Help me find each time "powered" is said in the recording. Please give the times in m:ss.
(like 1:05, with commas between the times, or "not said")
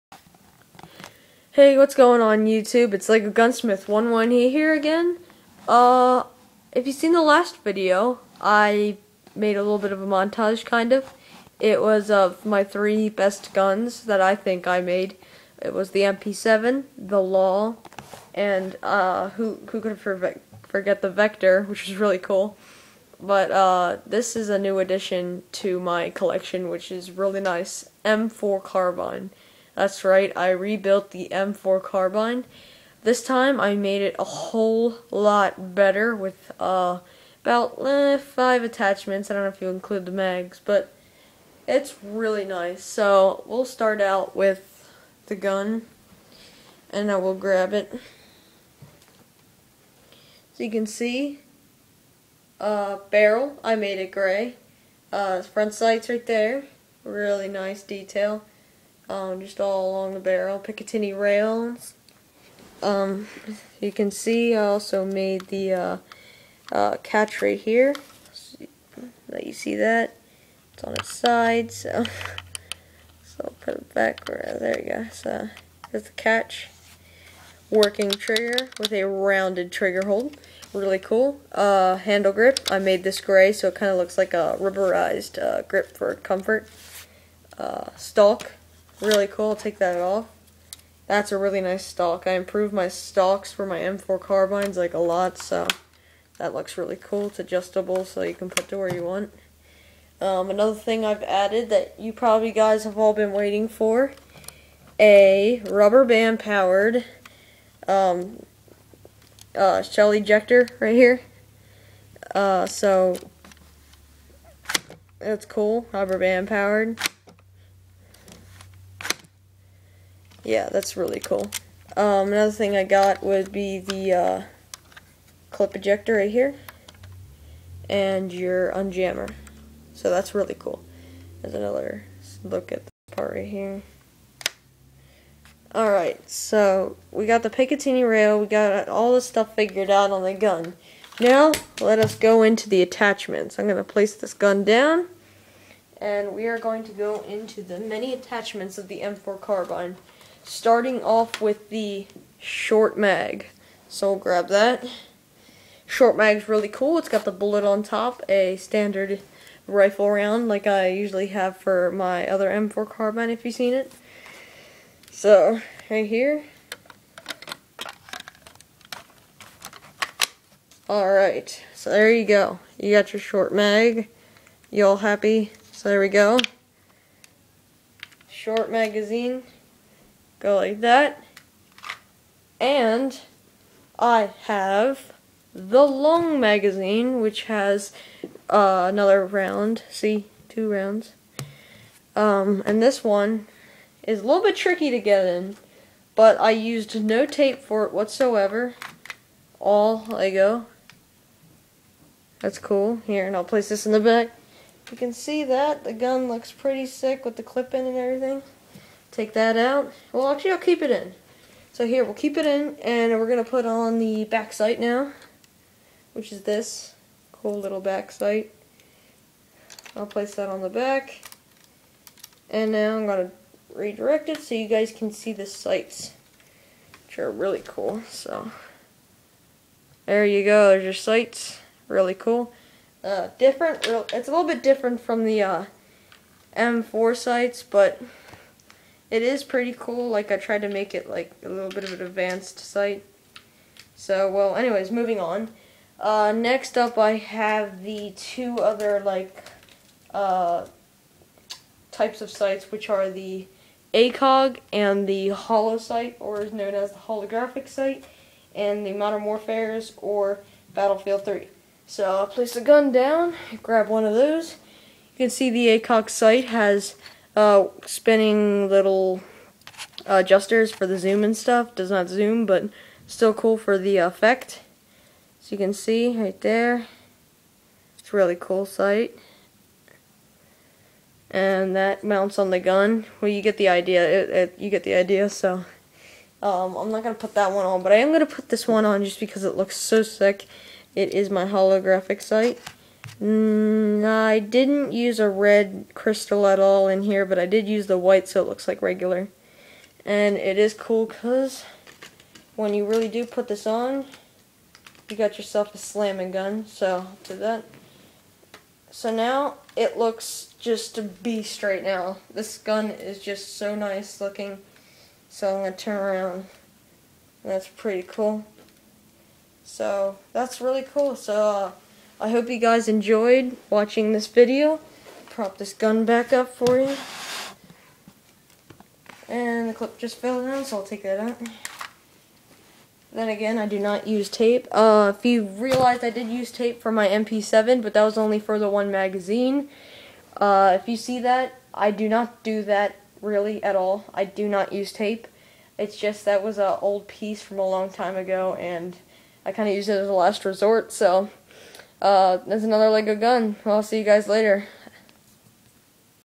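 1:46, 1:56.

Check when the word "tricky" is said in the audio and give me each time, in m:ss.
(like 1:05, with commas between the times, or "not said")
3:14.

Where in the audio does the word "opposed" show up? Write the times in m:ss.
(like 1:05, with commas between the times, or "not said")
not said.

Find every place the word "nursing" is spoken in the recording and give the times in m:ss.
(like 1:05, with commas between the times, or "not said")
not said.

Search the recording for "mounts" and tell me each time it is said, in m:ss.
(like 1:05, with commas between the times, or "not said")
4:42.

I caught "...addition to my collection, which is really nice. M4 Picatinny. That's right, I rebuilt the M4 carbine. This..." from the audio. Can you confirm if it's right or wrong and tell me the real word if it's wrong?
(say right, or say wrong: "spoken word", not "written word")
wrong: "Carbine", not "Picatinny".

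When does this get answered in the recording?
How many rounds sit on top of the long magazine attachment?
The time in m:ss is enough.
3:10.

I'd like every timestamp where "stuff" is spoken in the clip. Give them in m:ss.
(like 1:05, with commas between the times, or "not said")
2:19, 4:31.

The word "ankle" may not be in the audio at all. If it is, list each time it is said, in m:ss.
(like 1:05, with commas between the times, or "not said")
not said.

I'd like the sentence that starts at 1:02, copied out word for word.
Um, you can see I also made the uh, uh, catch right here.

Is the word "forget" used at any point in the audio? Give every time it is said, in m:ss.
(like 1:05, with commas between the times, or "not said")
0:19.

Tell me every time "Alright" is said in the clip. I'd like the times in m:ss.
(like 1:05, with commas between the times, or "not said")
2:15, 2:50.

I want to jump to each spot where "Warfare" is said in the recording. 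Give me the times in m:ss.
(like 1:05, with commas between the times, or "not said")
4:19.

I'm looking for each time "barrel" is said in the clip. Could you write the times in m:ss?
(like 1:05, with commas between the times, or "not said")
0:53, 1:00.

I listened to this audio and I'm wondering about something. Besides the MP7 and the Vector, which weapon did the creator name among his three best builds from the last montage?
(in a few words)
The Law.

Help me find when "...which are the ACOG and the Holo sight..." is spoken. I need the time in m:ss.
4:12.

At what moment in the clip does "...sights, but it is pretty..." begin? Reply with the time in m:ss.
3:57.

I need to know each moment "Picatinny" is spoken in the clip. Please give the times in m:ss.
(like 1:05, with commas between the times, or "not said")
1:00, 2:17.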